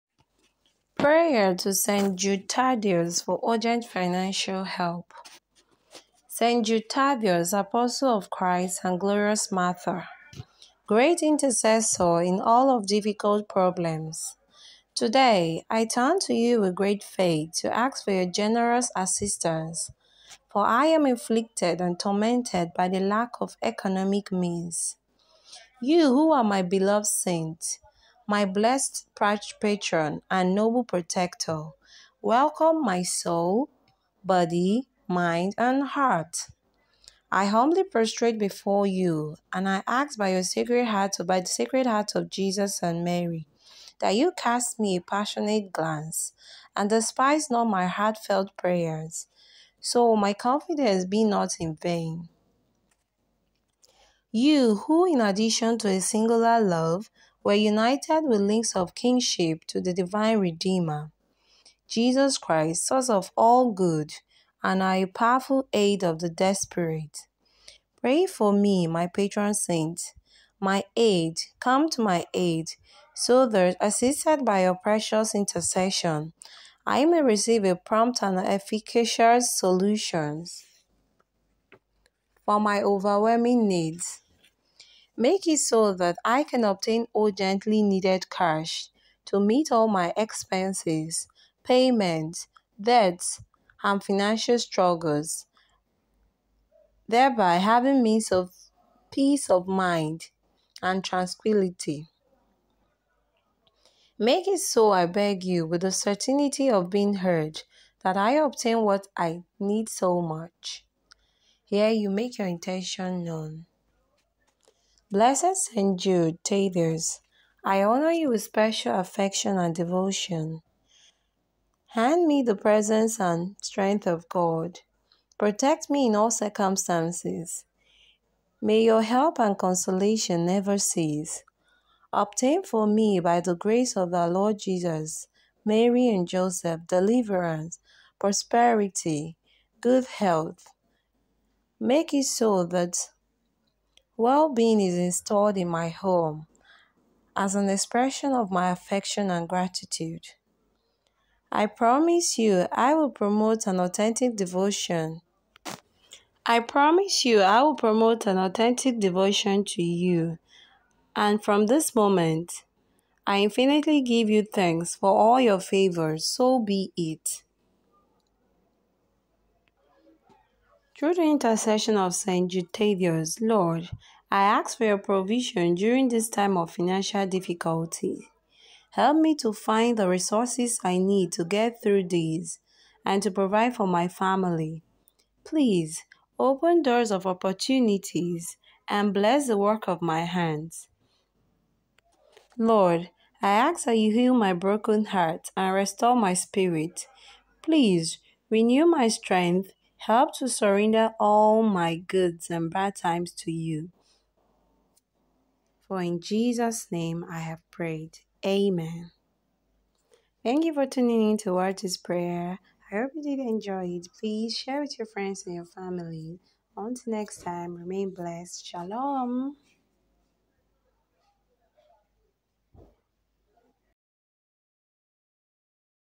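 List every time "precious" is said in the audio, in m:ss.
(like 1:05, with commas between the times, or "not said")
1:14.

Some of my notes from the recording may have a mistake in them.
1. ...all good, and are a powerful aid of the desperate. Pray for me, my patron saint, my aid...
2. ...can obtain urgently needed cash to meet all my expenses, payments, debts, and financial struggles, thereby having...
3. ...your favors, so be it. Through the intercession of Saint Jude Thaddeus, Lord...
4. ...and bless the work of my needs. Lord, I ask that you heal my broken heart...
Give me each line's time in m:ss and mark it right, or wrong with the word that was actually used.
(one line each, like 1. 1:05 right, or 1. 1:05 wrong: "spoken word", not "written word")
1. 1:03 right
2. 1:26 right
3. 2:45 right
4. 3:08 wrong: "hands", not "needs".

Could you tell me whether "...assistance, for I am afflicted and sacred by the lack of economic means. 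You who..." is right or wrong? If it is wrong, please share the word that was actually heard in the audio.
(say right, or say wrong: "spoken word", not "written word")
wrong: "tormented", not "sacred".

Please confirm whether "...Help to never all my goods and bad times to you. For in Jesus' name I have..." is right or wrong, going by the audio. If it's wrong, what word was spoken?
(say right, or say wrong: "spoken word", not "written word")
wrong: "surrender", not "never".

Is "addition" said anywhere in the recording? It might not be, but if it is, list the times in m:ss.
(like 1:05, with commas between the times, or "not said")
0:55.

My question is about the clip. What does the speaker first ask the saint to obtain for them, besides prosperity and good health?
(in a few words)
deliverance.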